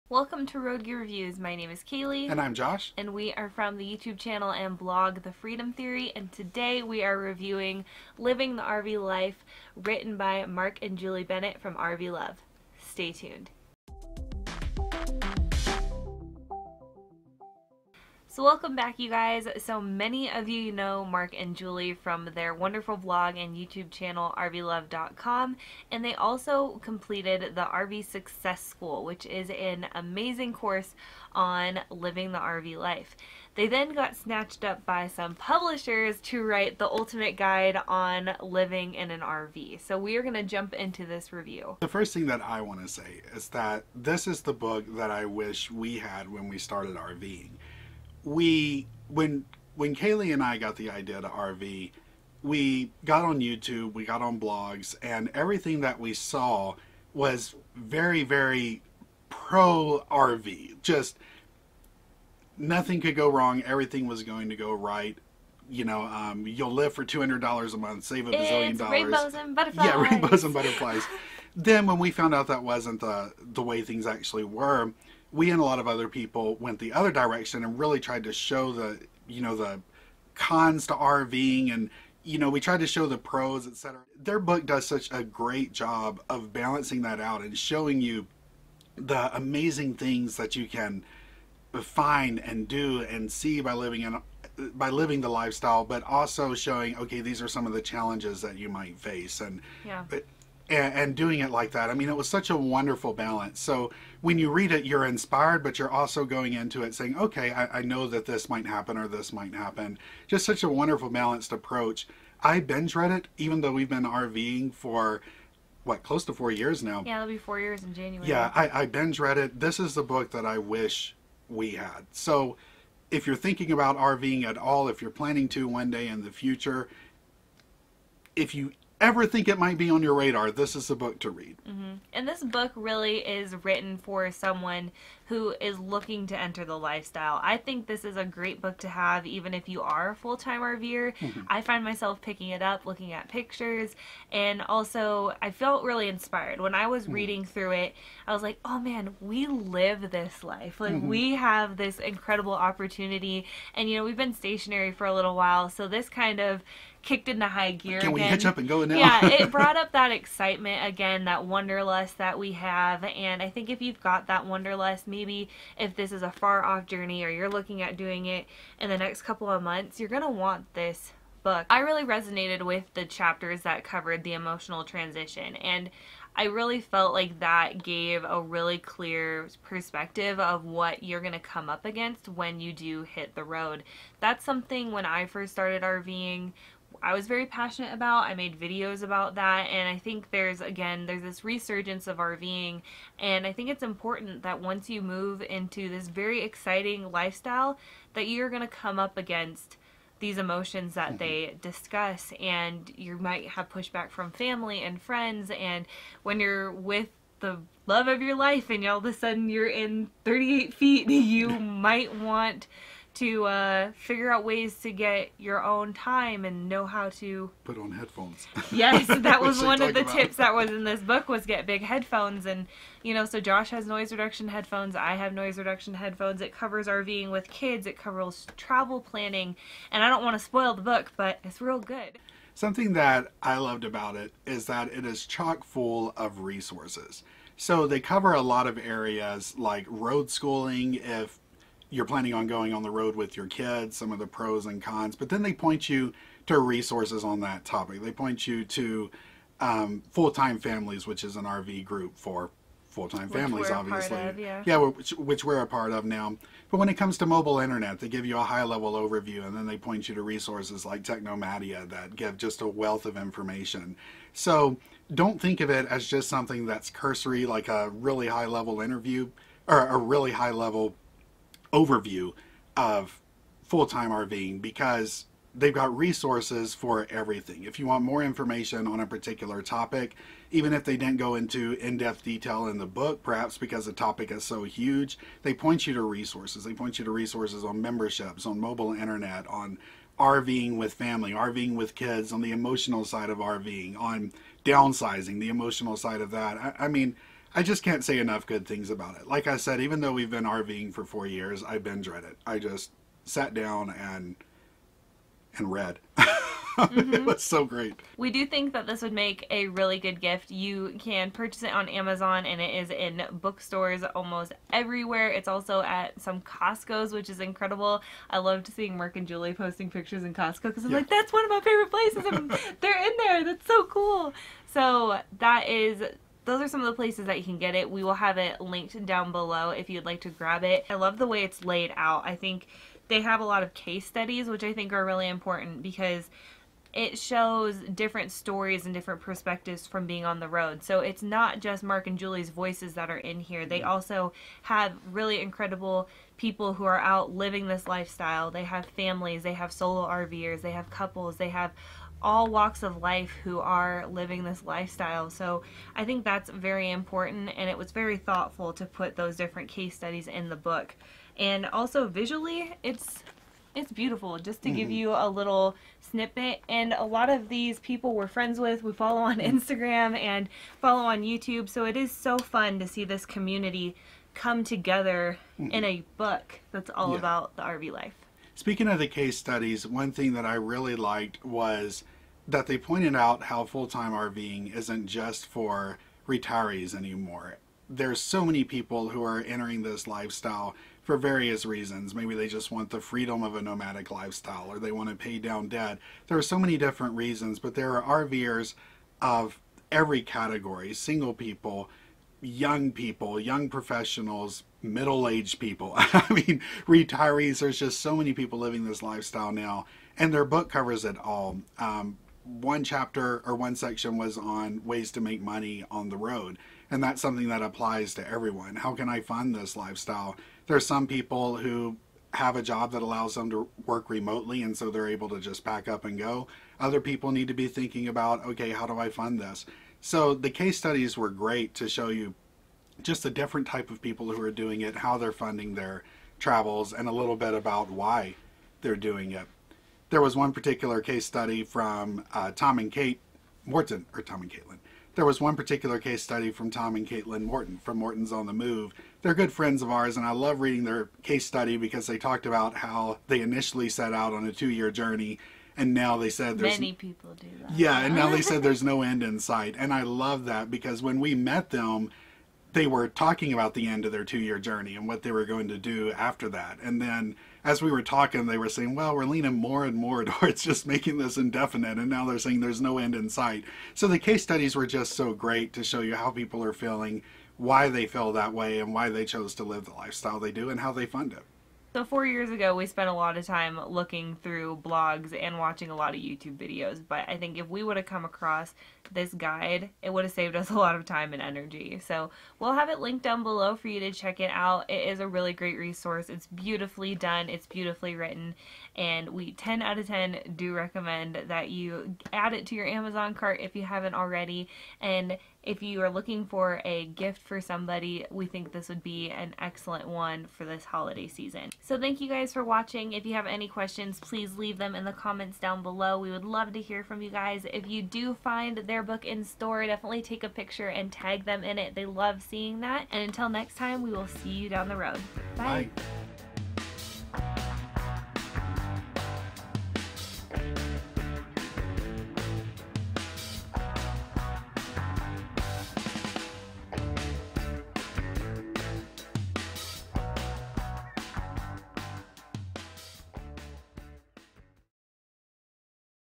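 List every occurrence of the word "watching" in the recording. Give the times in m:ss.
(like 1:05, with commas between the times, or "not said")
8:05, 8:32.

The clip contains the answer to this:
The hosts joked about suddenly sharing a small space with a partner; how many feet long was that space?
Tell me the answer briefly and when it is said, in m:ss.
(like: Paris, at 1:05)
38 feet, at 3:30.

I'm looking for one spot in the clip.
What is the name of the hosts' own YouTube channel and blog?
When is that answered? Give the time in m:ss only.
0:05.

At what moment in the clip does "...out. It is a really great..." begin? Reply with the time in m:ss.
8:14.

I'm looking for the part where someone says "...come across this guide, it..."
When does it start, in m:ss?
8:08.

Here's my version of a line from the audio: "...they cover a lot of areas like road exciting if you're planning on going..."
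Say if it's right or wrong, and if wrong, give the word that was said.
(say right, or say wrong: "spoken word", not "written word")
wrong: "schooling", not "exciting".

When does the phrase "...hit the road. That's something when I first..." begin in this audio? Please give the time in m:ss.
3:03.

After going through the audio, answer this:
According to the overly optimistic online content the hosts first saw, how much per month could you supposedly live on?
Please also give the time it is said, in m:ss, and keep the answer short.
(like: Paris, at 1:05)
$200, at 1:07.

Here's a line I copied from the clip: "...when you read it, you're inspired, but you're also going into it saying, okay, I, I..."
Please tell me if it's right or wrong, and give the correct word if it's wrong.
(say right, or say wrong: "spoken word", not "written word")
right.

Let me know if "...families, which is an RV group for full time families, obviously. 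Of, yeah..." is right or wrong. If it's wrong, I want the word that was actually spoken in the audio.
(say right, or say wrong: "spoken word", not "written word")
right.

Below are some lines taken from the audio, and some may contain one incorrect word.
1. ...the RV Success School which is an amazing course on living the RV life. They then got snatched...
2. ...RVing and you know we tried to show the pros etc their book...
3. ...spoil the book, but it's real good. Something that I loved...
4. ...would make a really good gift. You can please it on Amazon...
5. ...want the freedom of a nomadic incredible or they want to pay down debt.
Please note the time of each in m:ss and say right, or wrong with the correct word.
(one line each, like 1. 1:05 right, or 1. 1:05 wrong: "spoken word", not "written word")
1. 0:27 right
2. 1:20 right
3. 3:50 right
4. 5:09 wrong: "purchase", not "please"
5. 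6:32 wrong: "lifestyle", not "incredible".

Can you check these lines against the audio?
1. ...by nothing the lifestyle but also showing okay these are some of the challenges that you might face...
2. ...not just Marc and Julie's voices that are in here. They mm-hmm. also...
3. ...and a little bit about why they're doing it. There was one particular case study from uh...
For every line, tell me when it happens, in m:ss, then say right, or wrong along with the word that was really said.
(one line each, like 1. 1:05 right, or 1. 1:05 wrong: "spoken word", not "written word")
1. 1:34 wrong: "living", not "nothing"
2. 5:41 right
3. 7:16 right.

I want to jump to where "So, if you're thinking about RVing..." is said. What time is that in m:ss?
2:02.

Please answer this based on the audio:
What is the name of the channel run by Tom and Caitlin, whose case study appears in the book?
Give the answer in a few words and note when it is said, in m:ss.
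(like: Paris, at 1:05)
Morton's on the Move, at 7:27.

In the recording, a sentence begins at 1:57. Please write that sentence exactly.
Yeah, it'll be four years in January.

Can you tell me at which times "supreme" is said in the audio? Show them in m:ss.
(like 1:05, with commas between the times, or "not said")
not said.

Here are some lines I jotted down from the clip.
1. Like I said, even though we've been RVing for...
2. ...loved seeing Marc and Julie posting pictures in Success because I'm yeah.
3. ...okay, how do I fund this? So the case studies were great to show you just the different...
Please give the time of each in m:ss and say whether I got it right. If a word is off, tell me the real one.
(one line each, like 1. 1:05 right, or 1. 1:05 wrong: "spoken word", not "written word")
1. 4:59 right
2. 5:18 wrong: "Costco", not "Success"
3. 7:08 right.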